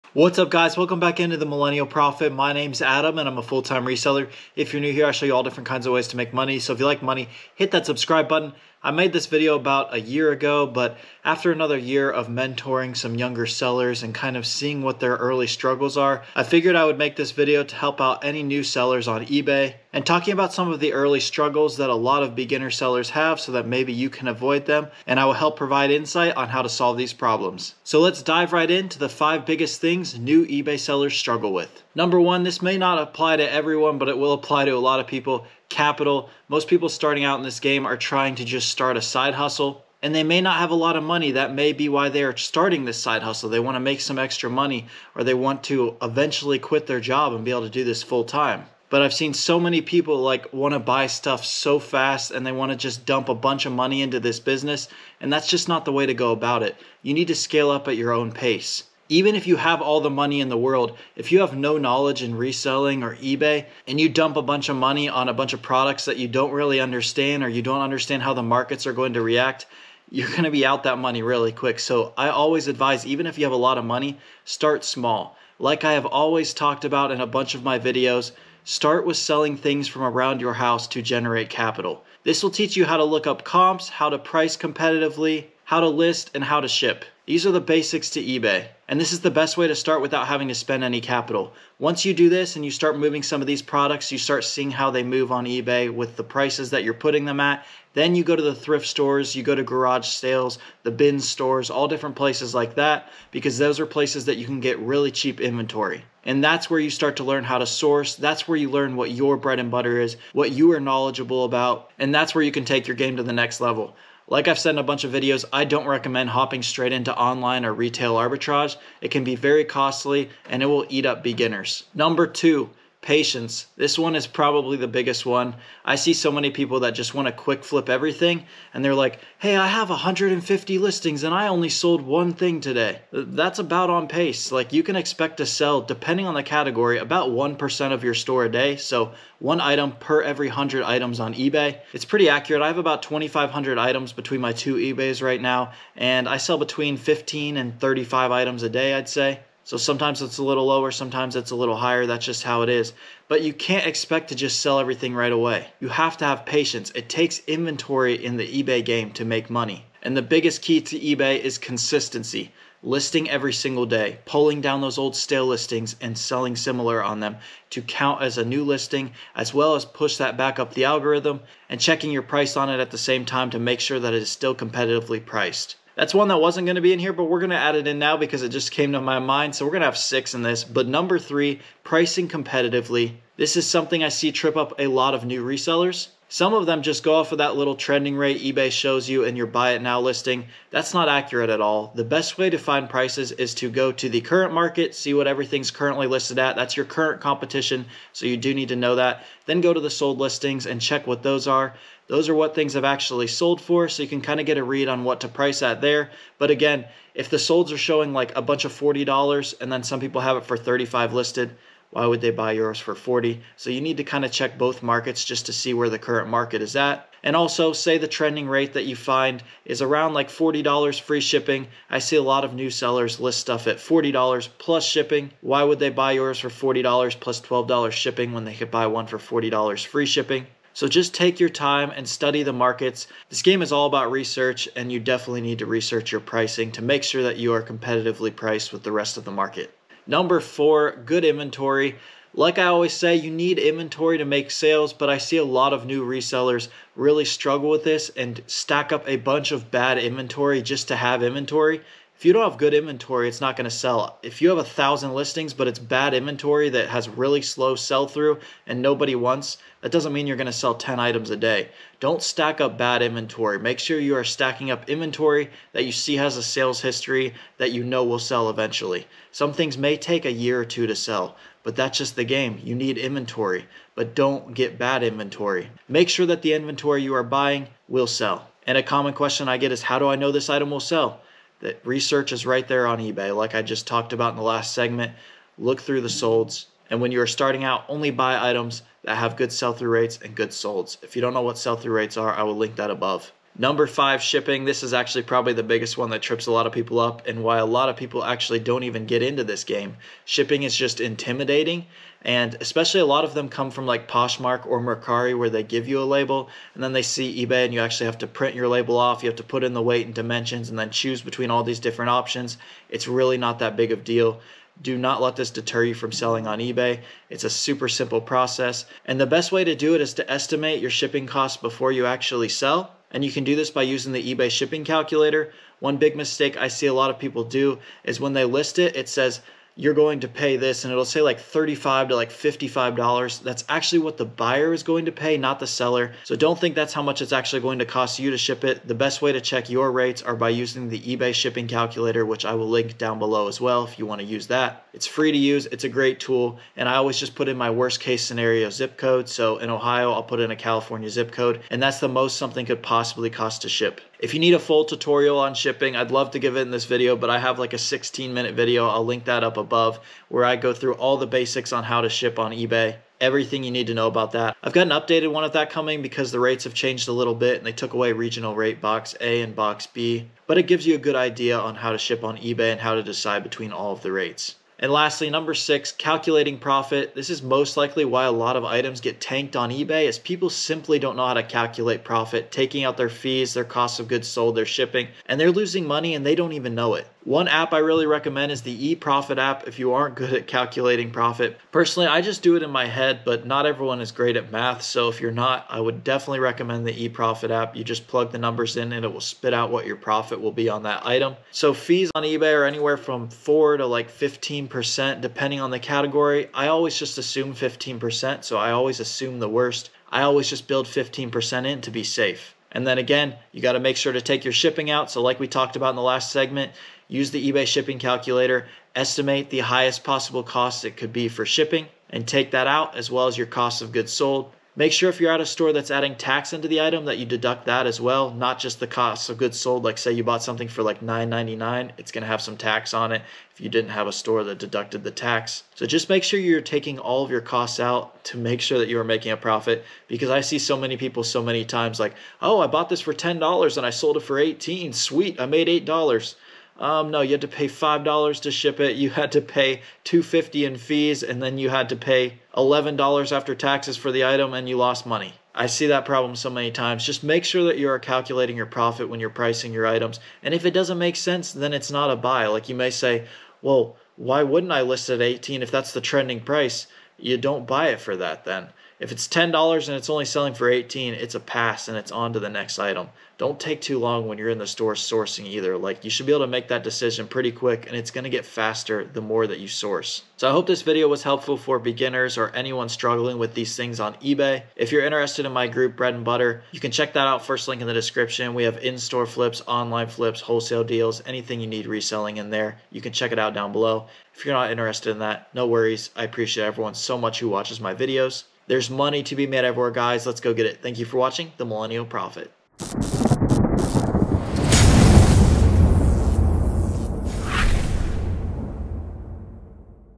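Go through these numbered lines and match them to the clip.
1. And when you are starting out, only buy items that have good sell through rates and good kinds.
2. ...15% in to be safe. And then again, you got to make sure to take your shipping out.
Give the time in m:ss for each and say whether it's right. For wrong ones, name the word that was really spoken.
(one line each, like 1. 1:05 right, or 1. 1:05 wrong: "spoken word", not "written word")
1. 4:46 wrong: "solds", not "kinds"
2. 6:50 right.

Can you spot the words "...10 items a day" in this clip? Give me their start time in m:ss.
4:20.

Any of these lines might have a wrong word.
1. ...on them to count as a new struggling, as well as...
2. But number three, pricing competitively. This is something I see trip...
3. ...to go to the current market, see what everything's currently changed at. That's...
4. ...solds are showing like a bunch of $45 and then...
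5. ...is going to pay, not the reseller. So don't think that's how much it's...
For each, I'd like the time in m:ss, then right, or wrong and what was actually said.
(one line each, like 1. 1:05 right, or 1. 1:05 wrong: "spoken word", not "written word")
1. 2:47 wrong: "listing", not "struggling"
2. 3:00 right
3. 3:13 wrong: "listed", not "changed"
4. 3:27 wrong: "40", not "45"
5. 5:34 wrong: "seller", not "reseller".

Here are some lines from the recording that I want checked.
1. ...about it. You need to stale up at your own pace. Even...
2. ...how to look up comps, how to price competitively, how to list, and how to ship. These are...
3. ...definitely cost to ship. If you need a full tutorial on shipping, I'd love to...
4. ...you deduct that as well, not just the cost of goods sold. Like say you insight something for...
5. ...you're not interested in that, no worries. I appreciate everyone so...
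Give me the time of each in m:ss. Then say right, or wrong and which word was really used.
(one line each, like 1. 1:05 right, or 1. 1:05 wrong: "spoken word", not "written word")
1. 0:56 wrong: "scale", not "stale"
2. 1:22 right
3. 5:52 wrong: "possibly", not "definitely"
4. 7:07 wrong: "bought", not "insight"
5. 8:14 right.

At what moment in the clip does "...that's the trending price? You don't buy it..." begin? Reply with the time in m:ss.
7:45.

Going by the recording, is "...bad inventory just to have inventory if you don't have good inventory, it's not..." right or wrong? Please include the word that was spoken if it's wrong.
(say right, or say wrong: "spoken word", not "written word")
right.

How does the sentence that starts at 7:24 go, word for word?
Sweet, I made $8." Um, no, you had to pay five dollars to ship it.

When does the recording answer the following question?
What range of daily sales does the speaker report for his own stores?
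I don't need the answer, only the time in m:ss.
2:26.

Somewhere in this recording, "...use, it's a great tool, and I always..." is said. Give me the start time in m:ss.
5:45.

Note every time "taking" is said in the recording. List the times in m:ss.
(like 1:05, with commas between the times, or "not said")
6:22, 7:16.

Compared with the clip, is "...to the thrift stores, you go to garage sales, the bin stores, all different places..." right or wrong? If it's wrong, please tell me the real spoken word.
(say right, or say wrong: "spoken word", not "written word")
right.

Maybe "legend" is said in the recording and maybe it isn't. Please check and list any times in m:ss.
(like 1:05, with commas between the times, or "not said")
not said.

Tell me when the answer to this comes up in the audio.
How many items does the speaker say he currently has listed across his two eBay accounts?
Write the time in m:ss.
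2:23.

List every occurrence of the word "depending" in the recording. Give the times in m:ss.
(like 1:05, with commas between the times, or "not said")
2:15, 6:45.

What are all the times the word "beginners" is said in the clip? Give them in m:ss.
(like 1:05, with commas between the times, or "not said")
0:22, 2:01, 8:01.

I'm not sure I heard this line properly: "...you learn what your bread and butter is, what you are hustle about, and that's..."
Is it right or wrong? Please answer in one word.
wrong.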